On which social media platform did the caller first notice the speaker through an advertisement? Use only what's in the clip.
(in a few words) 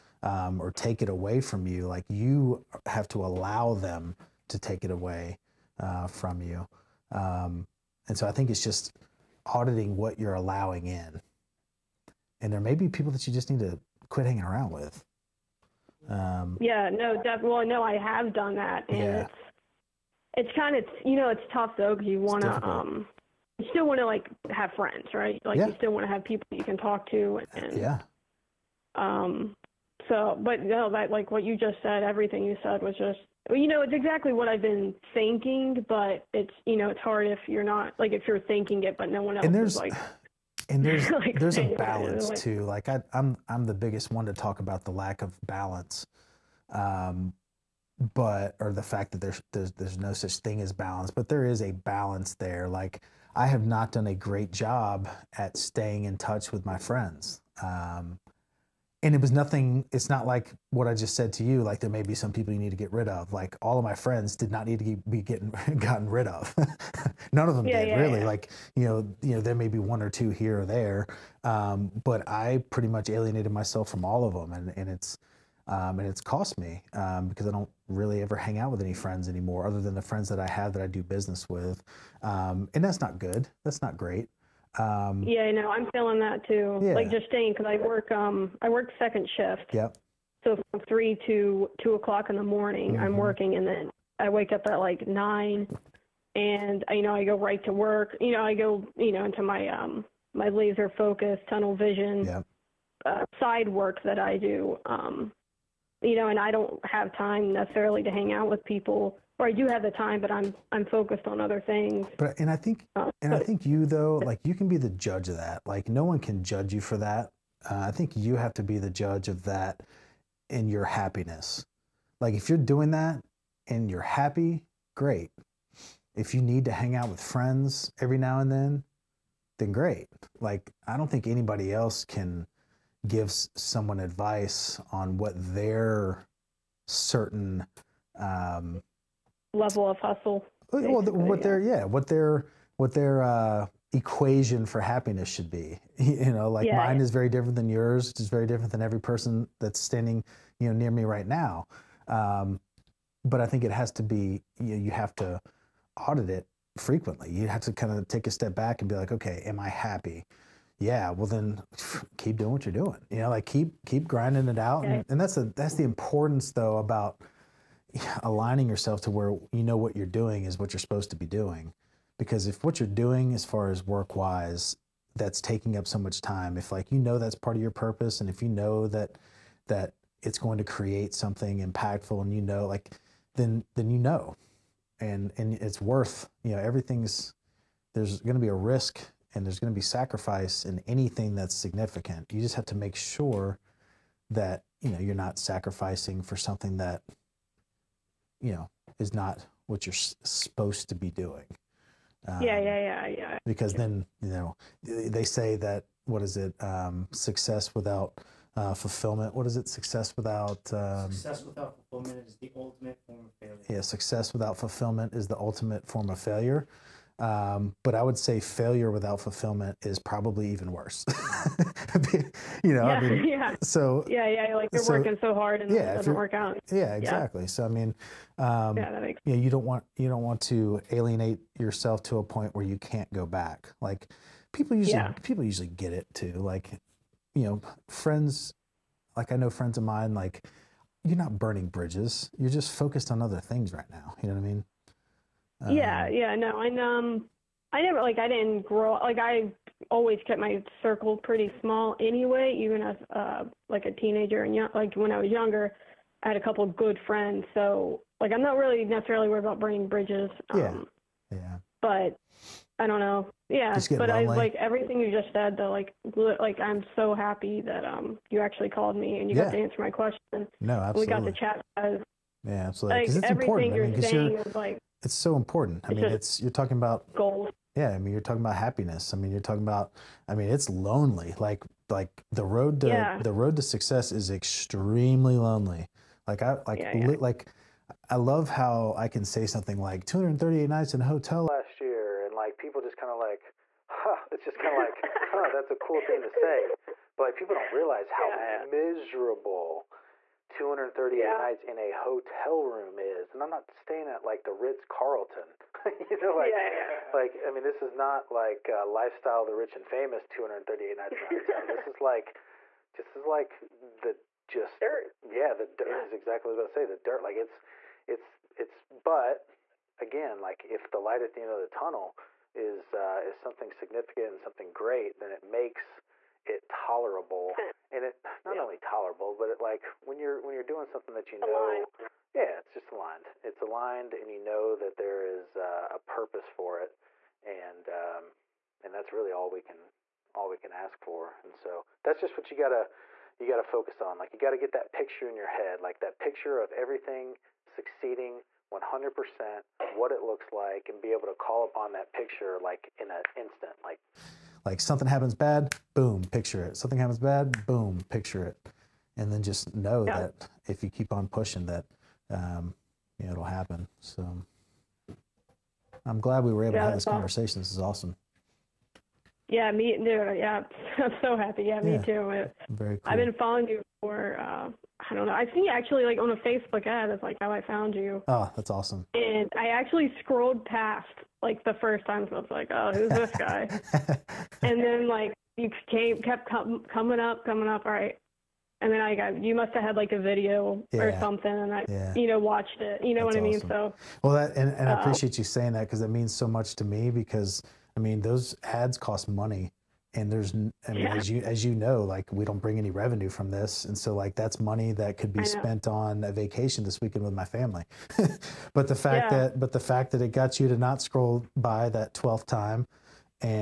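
Facebook.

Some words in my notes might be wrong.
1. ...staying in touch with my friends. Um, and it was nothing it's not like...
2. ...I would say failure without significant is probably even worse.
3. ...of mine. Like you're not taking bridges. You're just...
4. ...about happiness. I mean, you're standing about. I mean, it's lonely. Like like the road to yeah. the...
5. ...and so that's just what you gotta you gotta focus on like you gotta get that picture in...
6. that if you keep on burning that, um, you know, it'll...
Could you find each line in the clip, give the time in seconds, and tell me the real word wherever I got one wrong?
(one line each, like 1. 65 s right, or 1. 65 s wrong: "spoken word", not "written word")
1. 55 s right
2. 217 s wrong: "fulfillment", not "significant"
3. 239 s wrong: "burning", not "taking"
4. 278 s wrong: "talking", not "standing"
5. 341 s right
6. 360 s wrong: "pushing", not "burning".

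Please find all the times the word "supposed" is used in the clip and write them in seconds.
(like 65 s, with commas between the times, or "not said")
170 s, 200 s.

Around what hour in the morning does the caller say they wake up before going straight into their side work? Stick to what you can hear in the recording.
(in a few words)
9.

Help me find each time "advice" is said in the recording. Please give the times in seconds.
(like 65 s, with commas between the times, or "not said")
134 s.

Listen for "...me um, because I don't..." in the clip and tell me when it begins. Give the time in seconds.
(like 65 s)
76 s.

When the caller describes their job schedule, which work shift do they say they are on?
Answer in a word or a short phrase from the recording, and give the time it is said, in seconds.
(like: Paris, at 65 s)
second shift, at 88 s.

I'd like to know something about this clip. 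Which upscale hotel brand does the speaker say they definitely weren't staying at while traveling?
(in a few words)
Ritz Carlton.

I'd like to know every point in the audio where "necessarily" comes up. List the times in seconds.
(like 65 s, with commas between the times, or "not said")
107 s, 258 s.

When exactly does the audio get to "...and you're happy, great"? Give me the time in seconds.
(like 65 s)
123 s.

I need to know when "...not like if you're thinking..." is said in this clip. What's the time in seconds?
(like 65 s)
37 s.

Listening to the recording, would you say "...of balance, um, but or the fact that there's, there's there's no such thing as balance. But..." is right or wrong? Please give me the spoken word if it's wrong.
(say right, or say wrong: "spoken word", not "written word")
right.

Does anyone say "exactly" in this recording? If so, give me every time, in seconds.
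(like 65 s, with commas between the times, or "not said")
33 s, 226 s, 316 s.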